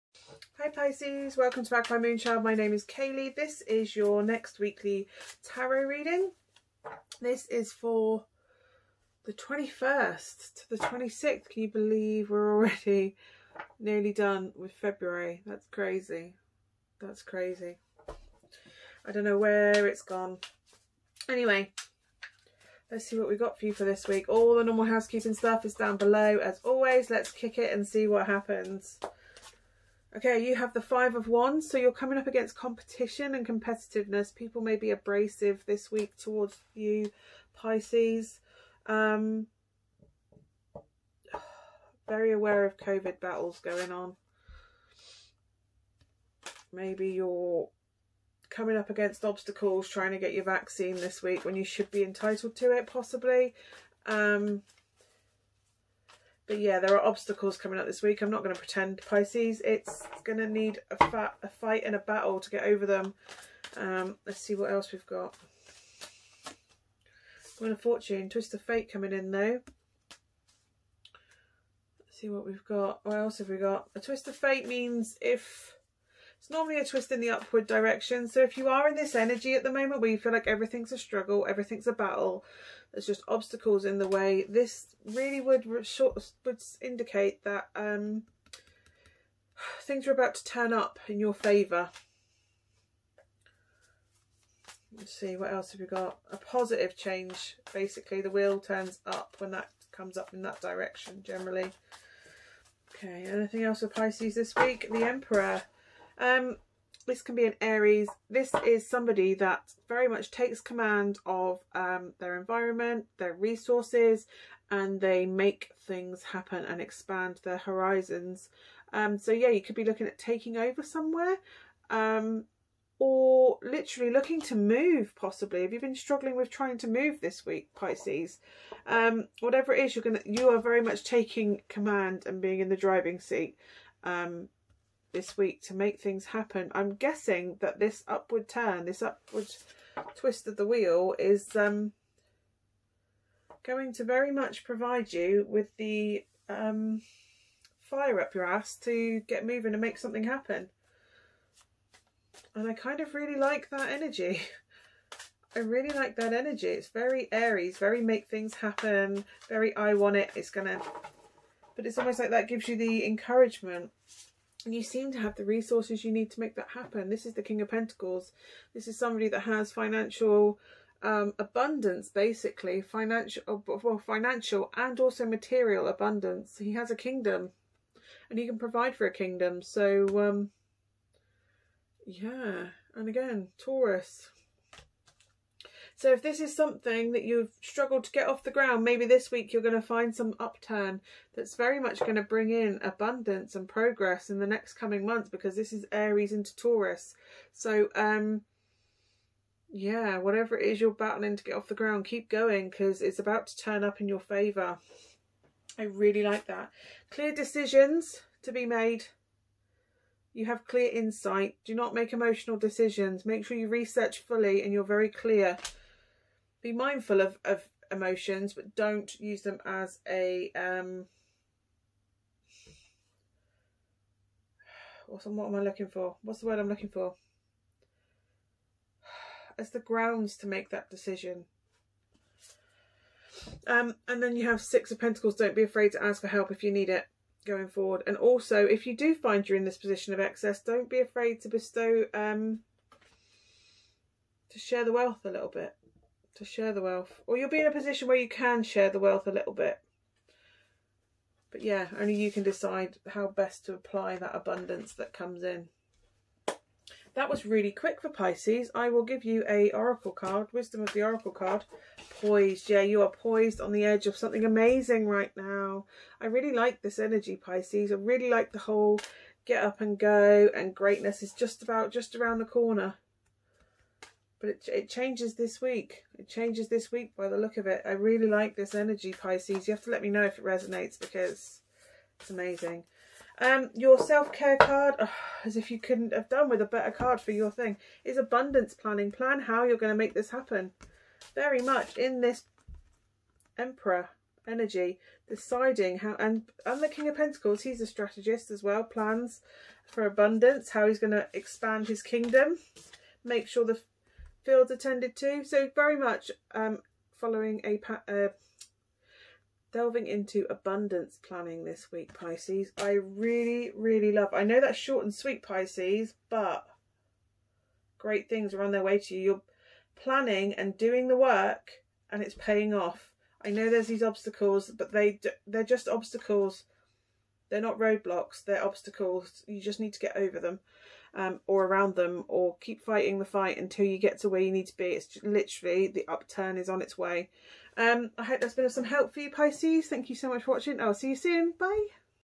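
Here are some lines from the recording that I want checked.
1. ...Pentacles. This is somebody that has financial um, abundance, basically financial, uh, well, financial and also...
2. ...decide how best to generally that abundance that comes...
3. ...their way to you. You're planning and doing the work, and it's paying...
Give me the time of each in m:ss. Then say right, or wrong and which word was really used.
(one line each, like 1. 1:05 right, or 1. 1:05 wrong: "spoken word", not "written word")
1. 2:47 right
2. 4:12 wrong: "apply", not "generally"
3. 5:18 right.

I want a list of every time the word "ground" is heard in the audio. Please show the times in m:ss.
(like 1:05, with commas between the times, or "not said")
3:08, 3:21, 3:49.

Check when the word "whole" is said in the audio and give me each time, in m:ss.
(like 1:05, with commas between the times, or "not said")
4:28.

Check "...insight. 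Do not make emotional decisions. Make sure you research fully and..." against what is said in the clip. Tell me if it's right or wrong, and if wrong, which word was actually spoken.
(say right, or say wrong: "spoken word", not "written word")
right.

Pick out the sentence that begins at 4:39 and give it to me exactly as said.
You have to let me know if it resonates because it's amazing.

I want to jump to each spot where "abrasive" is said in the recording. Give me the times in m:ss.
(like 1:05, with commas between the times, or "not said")
0:34.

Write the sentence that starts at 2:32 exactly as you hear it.
And I kind of really like that energy.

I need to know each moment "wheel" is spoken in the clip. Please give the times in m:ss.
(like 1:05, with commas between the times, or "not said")
1:07, 1:38, 2:20.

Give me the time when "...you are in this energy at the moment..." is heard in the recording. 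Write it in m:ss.
1:18.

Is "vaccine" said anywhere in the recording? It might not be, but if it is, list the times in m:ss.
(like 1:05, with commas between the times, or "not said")
0:50.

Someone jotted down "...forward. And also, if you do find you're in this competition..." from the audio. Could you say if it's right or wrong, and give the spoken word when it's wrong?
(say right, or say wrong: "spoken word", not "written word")
wrong: "position", not "competition".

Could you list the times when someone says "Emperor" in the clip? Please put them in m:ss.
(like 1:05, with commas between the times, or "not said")
1:45, 4:53.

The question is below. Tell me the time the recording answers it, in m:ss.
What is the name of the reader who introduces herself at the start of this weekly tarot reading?
0:02.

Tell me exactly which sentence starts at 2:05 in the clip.
Have you been struggling with trying to move this week, Pisces?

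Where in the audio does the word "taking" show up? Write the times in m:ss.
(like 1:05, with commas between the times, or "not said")
2:00, 2:11.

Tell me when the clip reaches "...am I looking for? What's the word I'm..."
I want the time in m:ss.
3:45.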